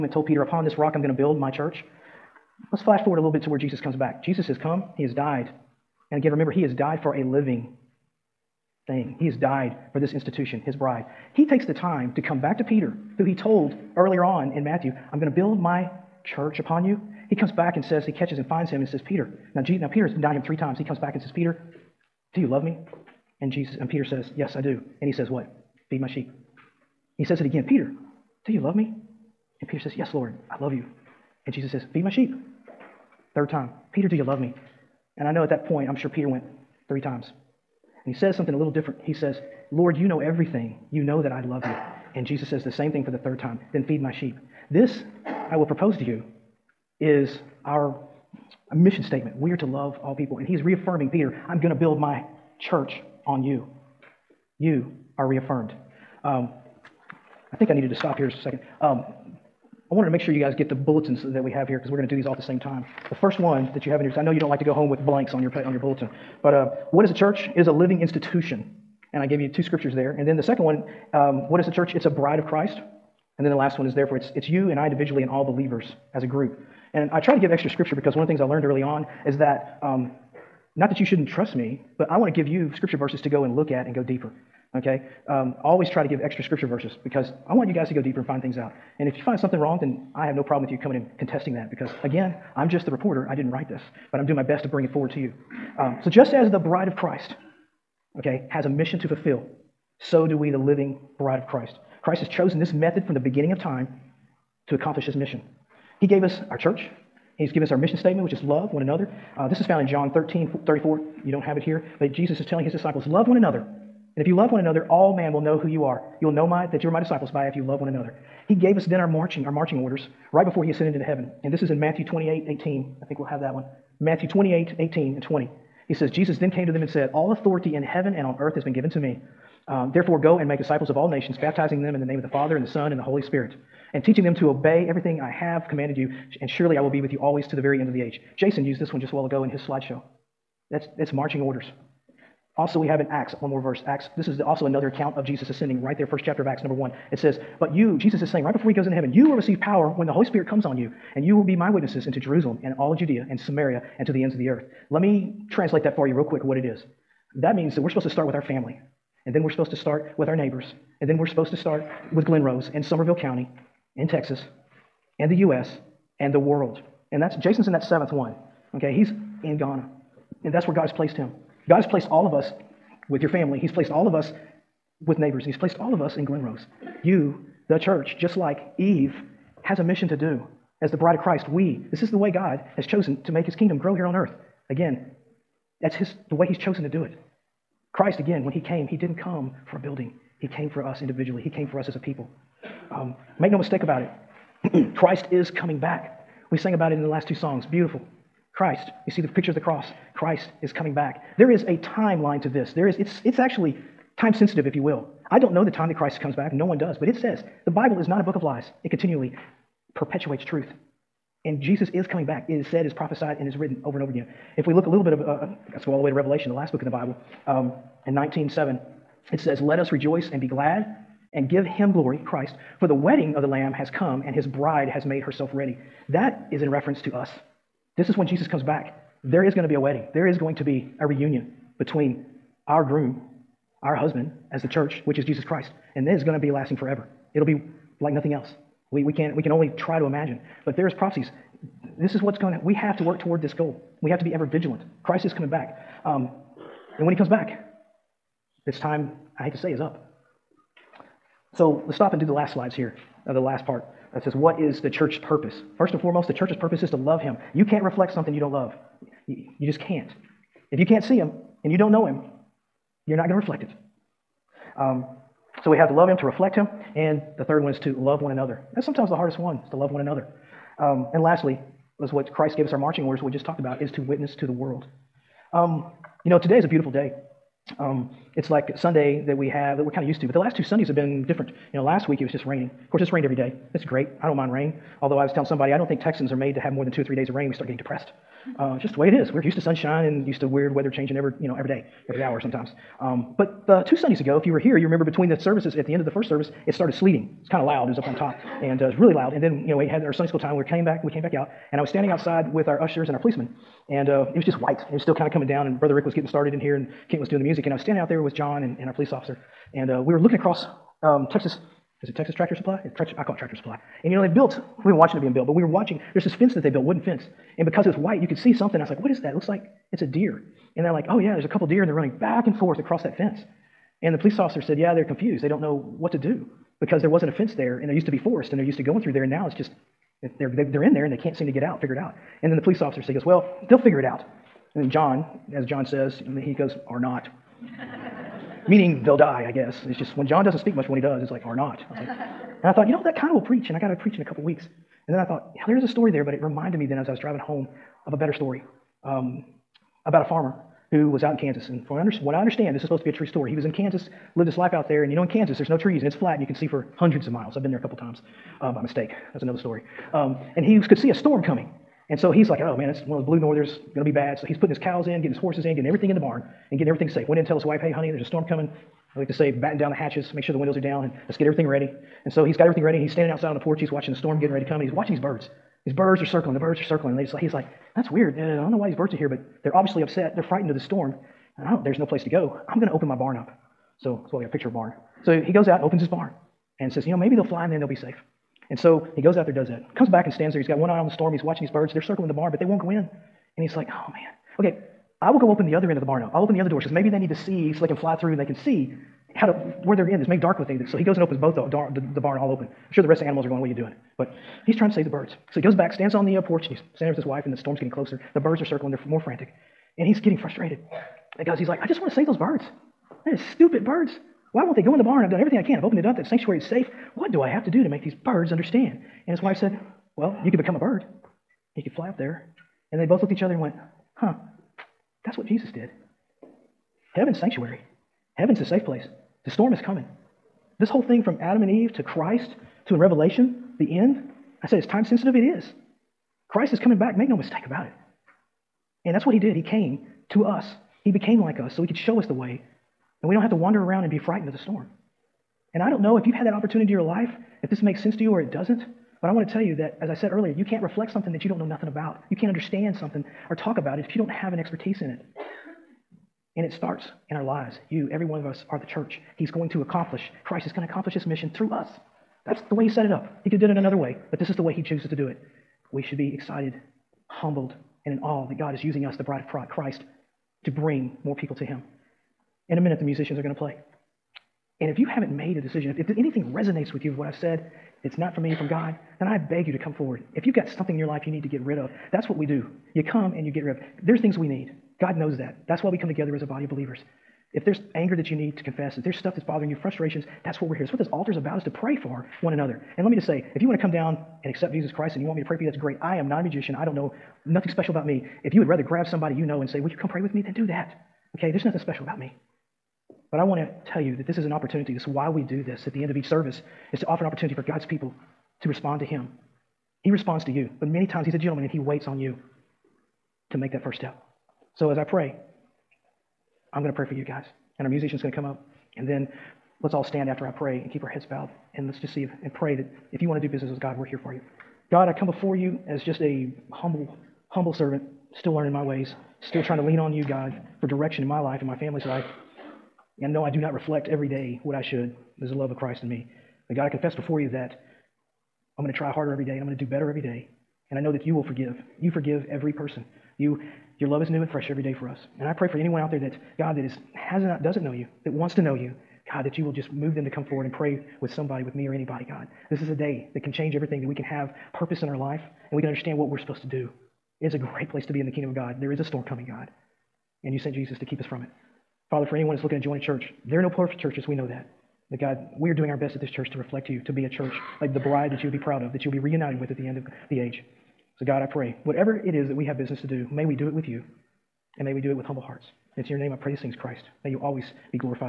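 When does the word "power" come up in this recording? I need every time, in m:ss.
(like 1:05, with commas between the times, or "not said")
2:29.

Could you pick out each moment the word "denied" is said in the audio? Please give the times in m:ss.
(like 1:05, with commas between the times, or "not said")
0:20.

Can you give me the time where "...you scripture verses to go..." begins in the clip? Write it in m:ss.
1:22.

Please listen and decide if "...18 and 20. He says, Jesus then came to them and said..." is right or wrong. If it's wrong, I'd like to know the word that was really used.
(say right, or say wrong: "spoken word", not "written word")
right.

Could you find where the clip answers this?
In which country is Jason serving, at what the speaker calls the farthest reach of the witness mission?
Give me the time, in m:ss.
2:49.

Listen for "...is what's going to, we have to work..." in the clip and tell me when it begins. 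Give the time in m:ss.
4:02.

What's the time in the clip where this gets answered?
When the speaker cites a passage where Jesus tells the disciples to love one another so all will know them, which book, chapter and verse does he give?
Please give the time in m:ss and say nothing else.
1:49.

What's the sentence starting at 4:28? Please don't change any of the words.
That's sometimes the hardest one, is to love one another.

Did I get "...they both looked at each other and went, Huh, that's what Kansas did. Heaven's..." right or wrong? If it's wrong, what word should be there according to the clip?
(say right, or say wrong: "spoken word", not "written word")
wrong: "Jesus", not "Kansas".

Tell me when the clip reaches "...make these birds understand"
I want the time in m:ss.
6:57.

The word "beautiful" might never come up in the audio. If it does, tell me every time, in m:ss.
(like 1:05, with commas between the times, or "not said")
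3:17, 4:36.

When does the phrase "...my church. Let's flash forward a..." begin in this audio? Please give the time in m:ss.
0:01.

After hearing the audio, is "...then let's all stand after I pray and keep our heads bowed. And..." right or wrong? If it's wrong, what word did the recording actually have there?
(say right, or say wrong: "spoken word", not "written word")
right.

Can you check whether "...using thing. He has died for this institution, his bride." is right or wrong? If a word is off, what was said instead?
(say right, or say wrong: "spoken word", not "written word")
wrong: "living", not "using".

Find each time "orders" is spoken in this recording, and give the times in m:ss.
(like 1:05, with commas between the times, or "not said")
1:59, 2:21, 4:33.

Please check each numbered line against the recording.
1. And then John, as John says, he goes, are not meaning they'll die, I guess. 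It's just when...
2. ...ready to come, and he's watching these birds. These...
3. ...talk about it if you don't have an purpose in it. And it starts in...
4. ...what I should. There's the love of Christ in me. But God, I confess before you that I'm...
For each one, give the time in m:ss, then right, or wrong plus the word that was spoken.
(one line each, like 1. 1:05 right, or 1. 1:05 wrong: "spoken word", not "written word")
1. 5:34 right
2. 6:14 right
3. 7:33 wrong: "expertise", not "purpose"
4. 8:54 right.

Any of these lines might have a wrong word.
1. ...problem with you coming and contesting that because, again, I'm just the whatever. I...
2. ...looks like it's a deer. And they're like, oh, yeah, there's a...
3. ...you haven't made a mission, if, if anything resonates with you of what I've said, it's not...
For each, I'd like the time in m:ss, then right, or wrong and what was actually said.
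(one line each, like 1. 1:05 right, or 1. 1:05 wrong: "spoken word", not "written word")
1. 1:30 wrong: "reporter", not "whatever"
2. 5:19 right
3. 7:54 wrong: "decision", not "mission".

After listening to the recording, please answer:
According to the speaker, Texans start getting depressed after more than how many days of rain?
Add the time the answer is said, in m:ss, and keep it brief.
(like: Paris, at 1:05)
two or three, at 4:46.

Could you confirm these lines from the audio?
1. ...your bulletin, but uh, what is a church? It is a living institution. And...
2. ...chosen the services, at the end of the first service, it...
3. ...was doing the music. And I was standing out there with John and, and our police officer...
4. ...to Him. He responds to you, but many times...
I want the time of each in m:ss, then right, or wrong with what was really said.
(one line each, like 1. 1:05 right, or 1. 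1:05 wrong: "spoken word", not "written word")
1. 1:05 right
2. 4:55 wrong: "between", not "chosen"
3. 5:07 right
4. 8:29 right.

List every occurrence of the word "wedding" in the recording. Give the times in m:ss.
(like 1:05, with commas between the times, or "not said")
3:42, 3:49.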